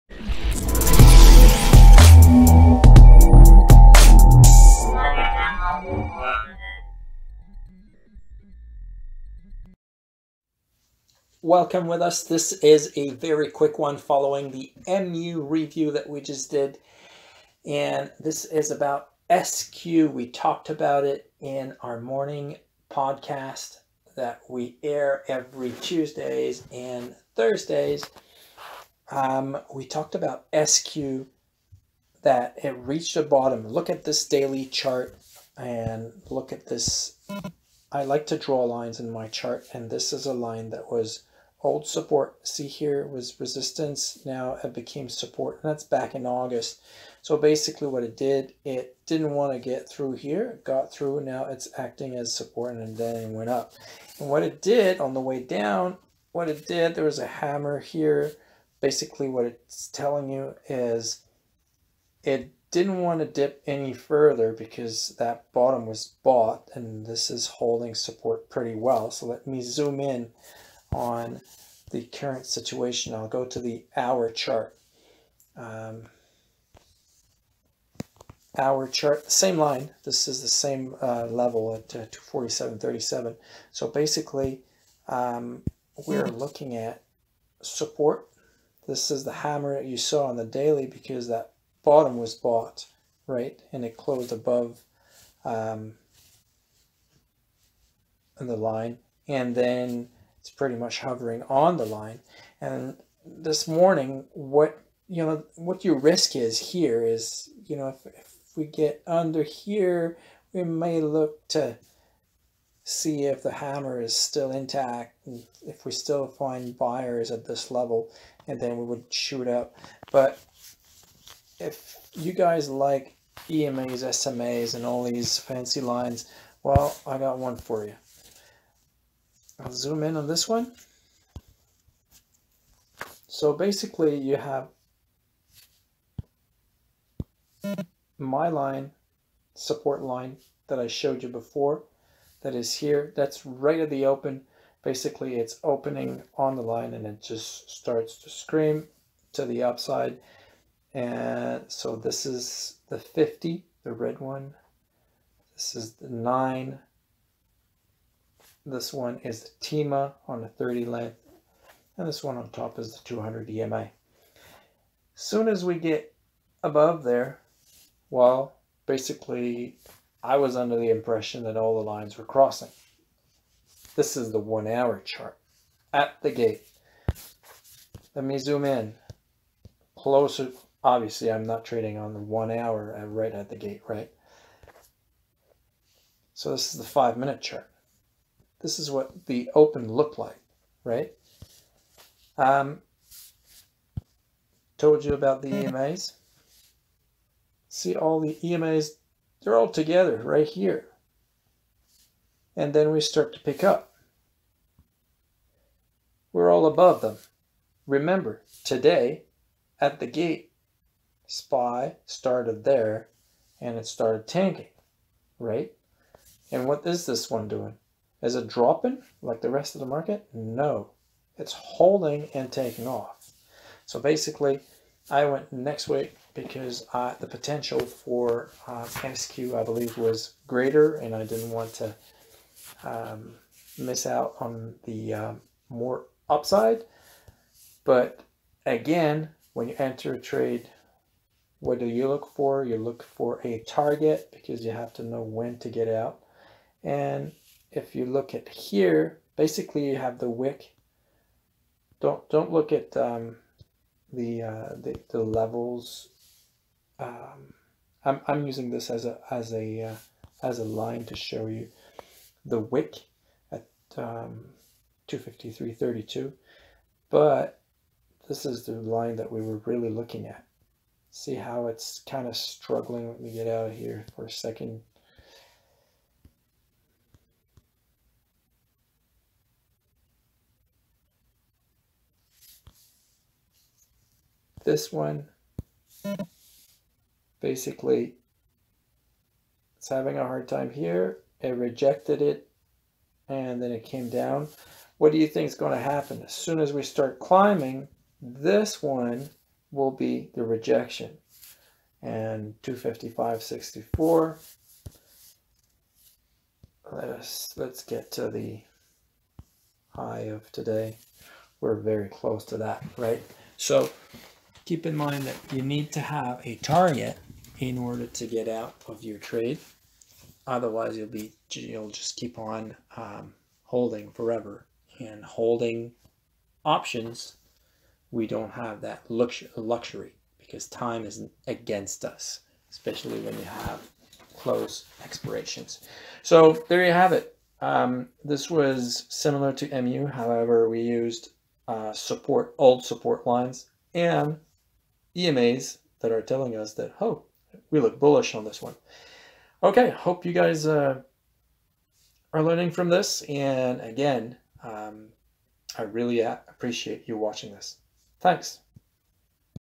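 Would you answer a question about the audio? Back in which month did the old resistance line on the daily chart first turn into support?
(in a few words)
August.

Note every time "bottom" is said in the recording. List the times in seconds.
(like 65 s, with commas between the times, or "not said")
33 s, 65 s, 91 s.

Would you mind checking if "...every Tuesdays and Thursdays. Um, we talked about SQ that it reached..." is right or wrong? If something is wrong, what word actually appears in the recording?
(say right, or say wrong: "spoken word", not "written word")
right.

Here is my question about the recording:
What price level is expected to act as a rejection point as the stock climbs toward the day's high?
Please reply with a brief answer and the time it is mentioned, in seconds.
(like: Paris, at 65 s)
255.64, at 302 s.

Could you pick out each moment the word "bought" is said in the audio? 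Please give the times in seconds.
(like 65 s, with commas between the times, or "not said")
66 s, 92 s.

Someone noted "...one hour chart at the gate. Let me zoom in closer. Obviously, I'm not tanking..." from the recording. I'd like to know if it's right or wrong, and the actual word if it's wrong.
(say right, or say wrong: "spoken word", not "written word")
wrong: "trading", not "tanking".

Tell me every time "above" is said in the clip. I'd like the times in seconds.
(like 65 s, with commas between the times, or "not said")
94 s, 166 s, 206 s.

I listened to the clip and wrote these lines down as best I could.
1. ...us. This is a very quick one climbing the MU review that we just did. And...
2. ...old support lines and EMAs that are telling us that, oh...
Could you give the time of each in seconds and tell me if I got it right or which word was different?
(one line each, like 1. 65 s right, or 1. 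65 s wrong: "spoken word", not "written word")
1. 12 s wrong: "following", not "climbing"
2. 342 s right.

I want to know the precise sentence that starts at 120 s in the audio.
But if you guys like EMAs, SMAs, and all these fancy lines, well, I got one for you.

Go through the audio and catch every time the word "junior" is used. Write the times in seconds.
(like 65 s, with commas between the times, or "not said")
not said.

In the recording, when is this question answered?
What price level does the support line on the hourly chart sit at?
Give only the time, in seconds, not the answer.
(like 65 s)
82 s.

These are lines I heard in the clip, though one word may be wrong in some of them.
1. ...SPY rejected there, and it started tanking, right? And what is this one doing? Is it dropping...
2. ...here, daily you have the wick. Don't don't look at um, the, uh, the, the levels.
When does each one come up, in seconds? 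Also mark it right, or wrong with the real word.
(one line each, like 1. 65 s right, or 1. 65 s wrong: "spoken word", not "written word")
1. 211 s wrong: "started", not "rejected"
2. 248 s wrong: "basically", not "daily".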